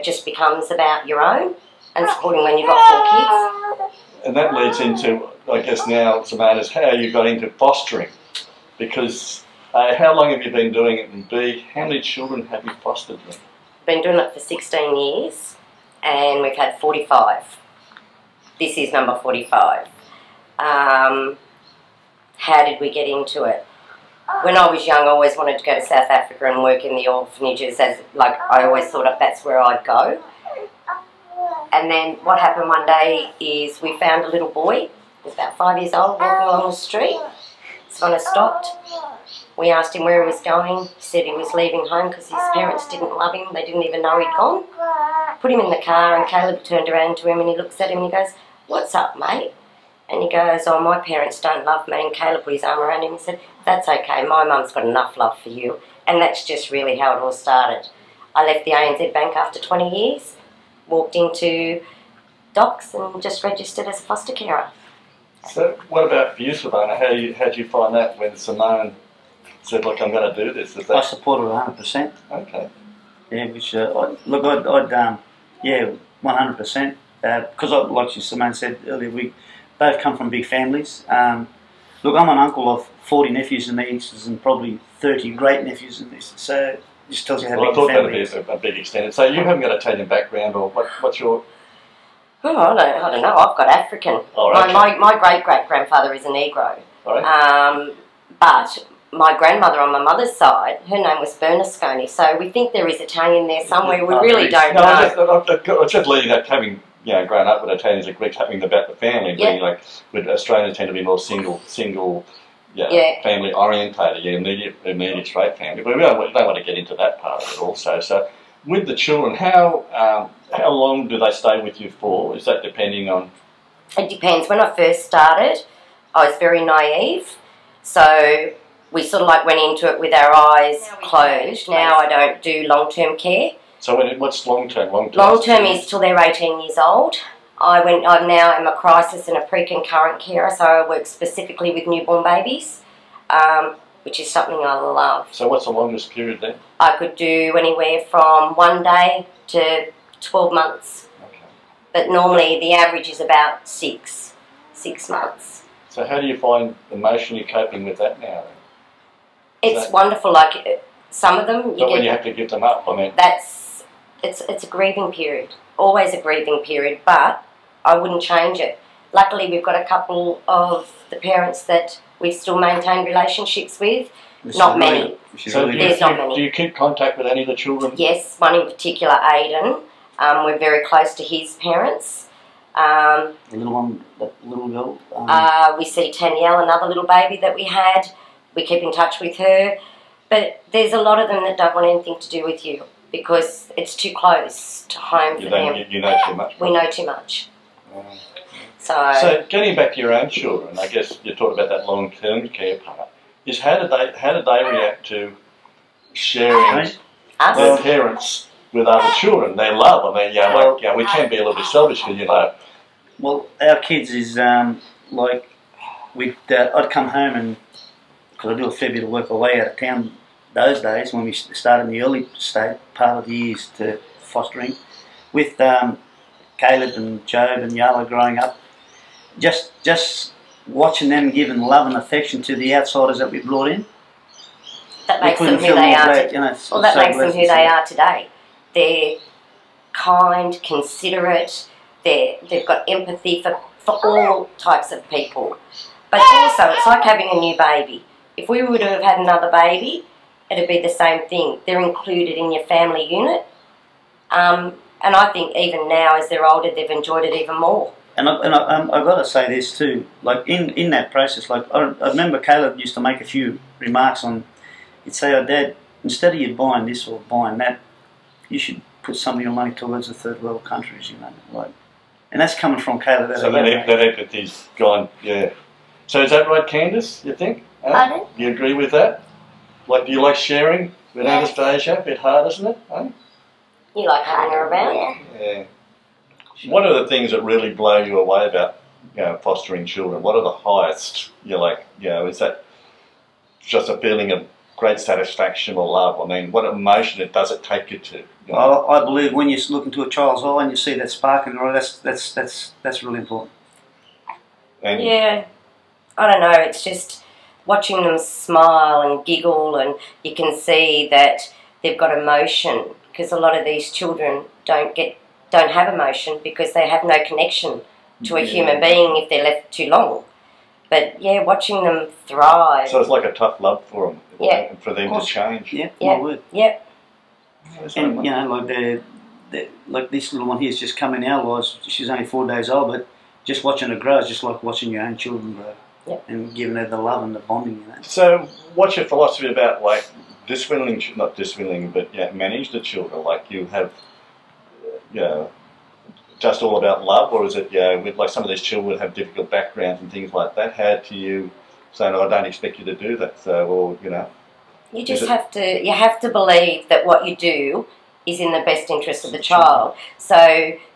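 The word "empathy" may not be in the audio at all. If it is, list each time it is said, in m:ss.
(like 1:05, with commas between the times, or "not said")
4:02, 4:33.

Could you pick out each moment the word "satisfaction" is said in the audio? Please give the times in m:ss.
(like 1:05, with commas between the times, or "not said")
4:54.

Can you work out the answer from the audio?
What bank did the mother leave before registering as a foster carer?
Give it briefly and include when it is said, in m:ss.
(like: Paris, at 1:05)
ANZ Bank, at 0:58.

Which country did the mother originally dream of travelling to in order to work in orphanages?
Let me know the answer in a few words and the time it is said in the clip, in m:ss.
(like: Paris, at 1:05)
South Africa, at 0:25.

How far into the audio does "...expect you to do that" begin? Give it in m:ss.
5:52.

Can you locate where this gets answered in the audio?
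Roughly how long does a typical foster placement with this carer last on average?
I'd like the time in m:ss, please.
2:34.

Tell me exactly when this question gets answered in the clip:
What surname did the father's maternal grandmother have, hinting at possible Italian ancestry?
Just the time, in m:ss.
1:41.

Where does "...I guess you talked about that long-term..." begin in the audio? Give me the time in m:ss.
3:20.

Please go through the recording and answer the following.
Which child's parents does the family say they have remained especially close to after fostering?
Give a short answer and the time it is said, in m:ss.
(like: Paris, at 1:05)
Aidan, at 2:59.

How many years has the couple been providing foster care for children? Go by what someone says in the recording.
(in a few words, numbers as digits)
16.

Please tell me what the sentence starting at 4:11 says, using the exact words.
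They're included in your family unit.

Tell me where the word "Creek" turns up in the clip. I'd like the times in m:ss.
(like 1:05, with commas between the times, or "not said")
not said.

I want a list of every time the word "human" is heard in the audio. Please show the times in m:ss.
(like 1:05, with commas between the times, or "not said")
5:18.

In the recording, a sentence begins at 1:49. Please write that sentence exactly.
being like with Australians tend to be more single, single, yeah, yeah.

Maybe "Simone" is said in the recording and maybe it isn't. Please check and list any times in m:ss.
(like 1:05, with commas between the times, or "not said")
1:08, 1:18.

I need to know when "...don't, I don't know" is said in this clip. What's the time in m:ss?
1:32.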